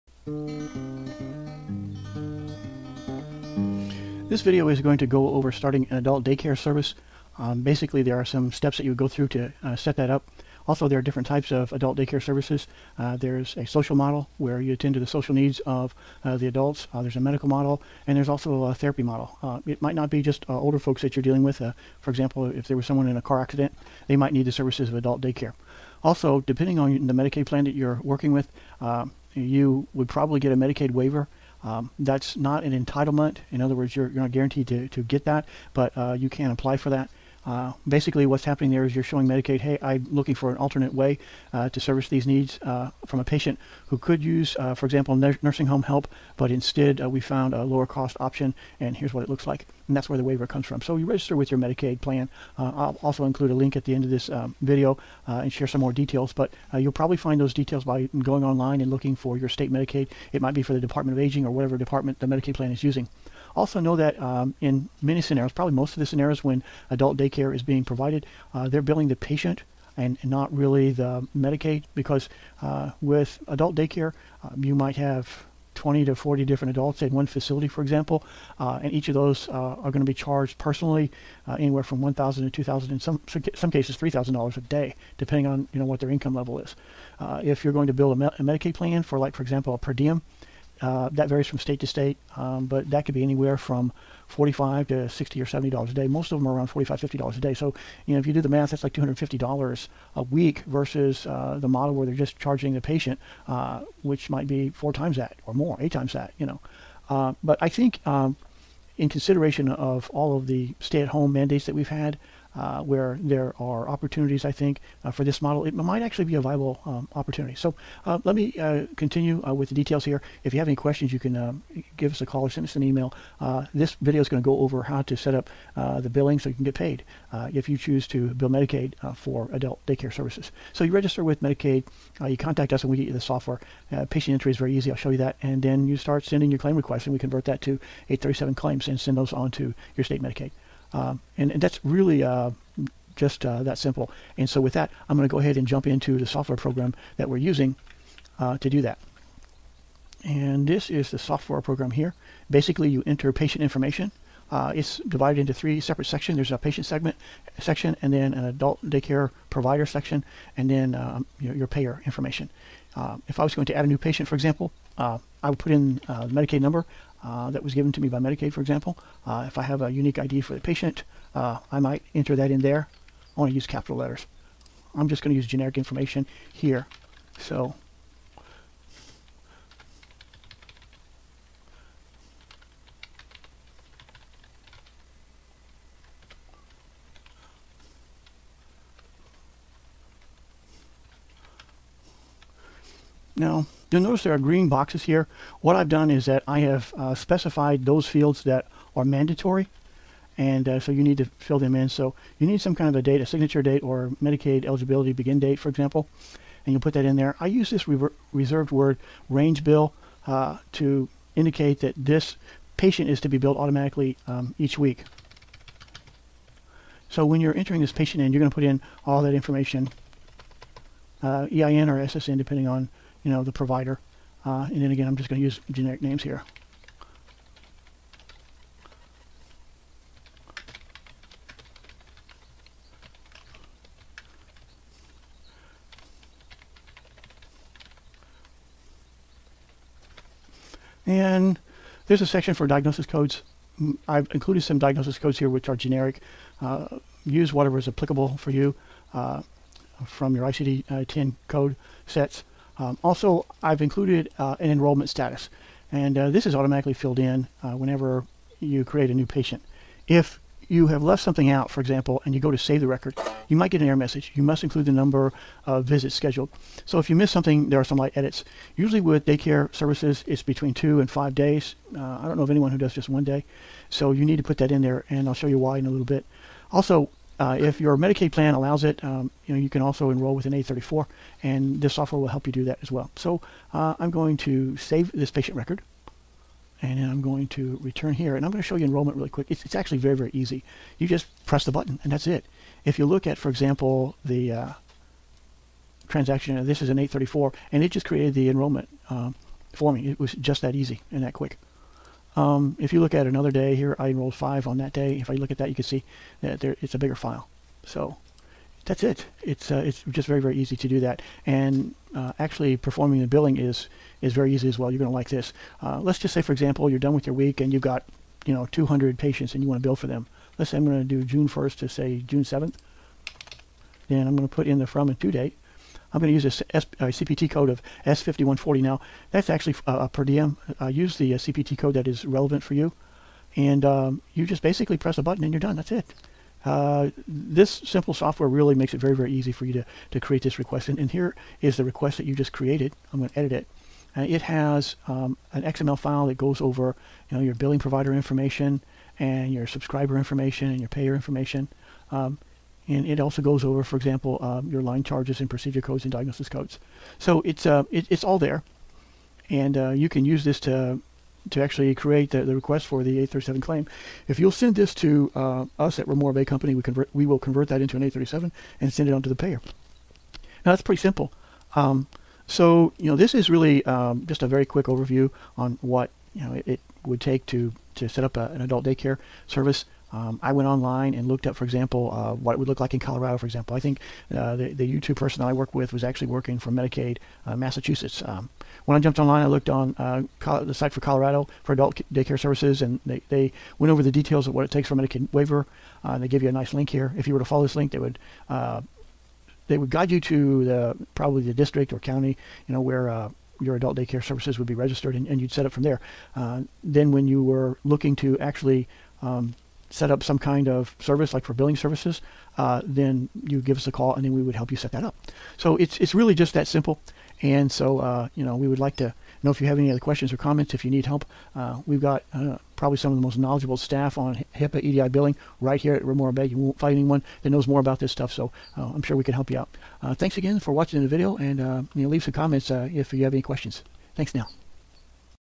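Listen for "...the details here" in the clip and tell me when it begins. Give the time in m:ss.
1:59.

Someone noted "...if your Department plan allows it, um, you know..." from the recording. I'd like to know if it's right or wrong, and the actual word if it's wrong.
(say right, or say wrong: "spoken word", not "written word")
wrong: "Medicaid", not "Department".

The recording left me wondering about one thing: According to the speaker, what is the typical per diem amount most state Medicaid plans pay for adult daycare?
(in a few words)
$45-50 a day.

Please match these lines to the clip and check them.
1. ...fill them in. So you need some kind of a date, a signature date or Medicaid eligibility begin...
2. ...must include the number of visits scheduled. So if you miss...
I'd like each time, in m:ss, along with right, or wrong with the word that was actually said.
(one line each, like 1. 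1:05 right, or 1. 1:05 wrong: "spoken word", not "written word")
1. 3:21 right
2. 4:24 right.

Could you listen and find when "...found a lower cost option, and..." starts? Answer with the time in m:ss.
0:47.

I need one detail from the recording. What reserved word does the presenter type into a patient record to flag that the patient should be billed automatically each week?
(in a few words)
range bill.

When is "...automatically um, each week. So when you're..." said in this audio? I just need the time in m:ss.
3:33.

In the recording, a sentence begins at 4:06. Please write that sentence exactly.
Uh, use whatever is applicable for you uh, from your ICD-10 uh, code sets.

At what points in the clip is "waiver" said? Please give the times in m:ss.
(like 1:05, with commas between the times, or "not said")
0:30, 0:50, 6:35.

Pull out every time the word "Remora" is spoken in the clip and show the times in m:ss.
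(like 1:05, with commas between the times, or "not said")
6:06, 7:06.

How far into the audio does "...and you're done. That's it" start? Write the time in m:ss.
5:35.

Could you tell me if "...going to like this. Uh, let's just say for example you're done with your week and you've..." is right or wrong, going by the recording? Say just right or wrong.
right.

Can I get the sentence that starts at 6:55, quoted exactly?
So it's, it's really just that simple.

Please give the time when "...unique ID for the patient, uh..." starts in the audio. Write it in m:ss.
2:49.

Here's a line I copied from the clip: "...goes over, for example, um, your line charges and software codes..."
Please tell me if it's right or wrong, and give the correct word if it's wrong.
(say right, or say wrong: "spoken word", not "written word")
wrong: "procedure", not "software".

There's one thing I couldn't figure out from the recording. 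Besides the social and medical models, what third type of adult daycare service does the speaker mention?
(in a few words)
therapy model.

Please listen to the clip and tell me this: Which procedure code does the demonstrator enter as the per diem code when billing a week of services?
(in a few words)
S5140.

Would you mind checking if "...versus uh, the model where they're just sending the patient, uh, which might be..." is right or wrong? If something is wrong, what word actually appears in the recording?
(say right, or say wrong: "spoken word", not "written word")
wrong: "charging", not "sending".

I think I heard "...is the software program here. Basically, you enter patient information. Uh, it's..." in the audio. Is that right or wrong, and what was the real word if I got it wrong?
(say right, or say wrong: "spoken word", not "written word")
right.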